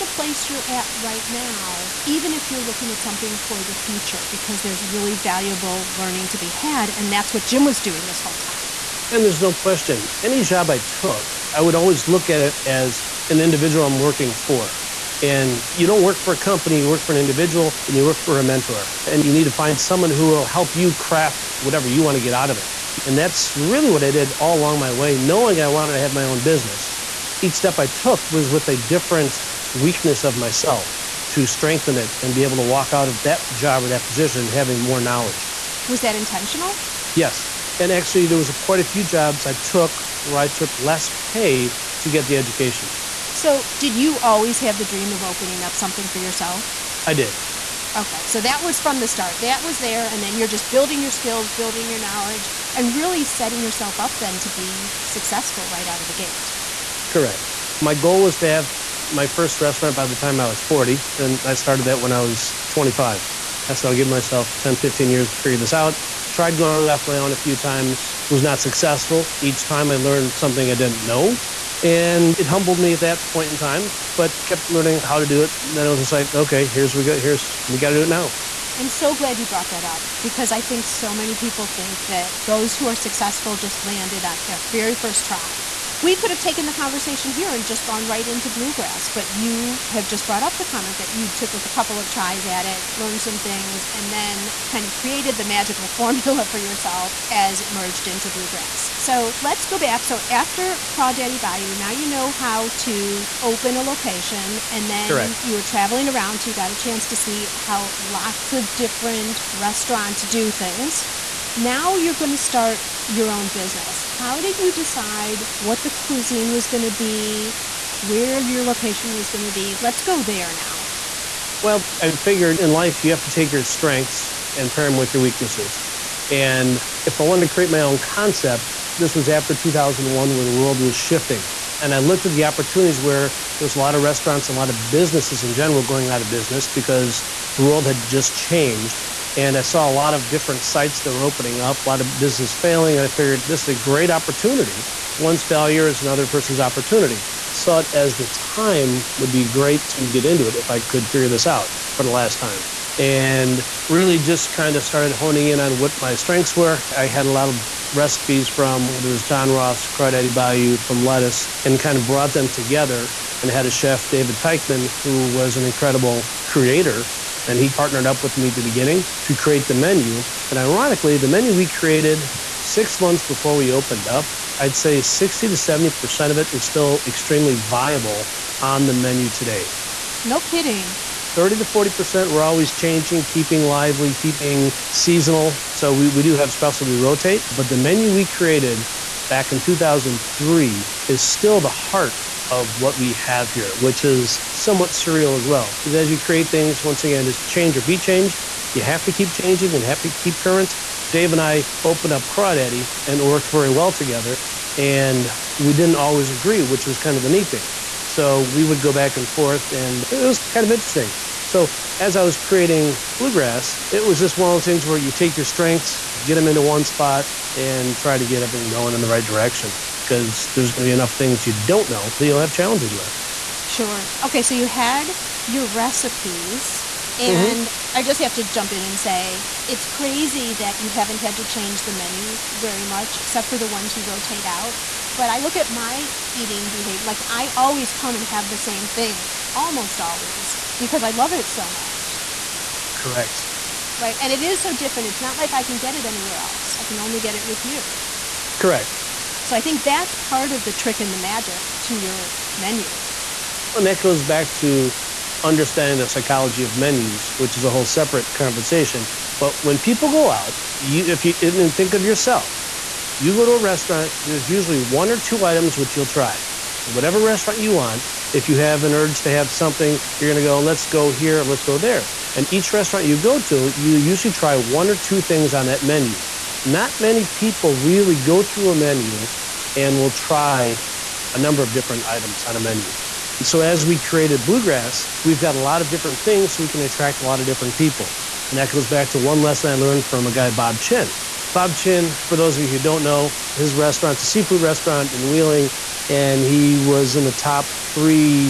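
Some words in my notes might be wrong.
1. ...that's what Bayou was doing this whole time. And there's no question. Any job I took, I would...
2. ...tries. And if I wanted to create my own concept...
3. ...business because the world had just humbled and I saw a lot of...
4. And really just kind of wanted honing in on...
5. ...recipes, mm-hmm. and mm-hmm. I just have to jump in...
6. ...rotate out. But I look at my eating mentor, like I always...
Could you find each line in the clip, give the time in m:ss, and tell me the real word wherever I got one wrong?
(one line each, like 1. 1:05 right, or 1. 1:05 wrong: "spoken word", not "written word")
1. 0:07 wrong: "Jim", not "Bayou"
2. 2:05 wrong: "weaknesses", not "tries"
3. 2:16 wrong: "changed", not "humbled"
4. 2:32 wrong: "started", not "wanted"
5. 3:45 right
6. 3:54 wrong: "behavior", not "mentor".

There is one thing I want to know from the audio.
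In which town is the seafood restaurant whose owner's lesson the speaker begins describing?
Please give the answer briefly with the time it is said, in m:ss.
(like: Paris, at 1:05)
Wheeling, at 4:55.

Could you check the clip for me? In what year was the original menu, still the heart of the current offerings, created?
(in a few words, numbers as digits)
2003.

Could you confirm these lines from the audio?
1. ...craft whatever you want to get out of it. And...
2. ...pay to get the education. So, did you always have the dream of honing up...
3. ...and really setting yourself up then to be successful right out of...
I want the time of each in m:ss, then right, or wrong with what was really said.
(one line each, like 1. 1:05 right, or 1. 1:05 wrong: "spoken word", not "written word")
1. 0:20 right
2. 0:41 wrong: "opening", not "honing"
3. 0:52 right.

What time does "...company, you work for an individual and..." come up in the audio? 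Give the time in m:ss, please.
0:16.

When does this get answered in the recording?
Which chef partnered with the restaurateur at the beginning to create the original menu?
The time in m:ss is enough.
2:44.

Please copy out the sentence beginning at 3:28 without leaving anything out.
So we would go back and forth, and it was kind of interesting.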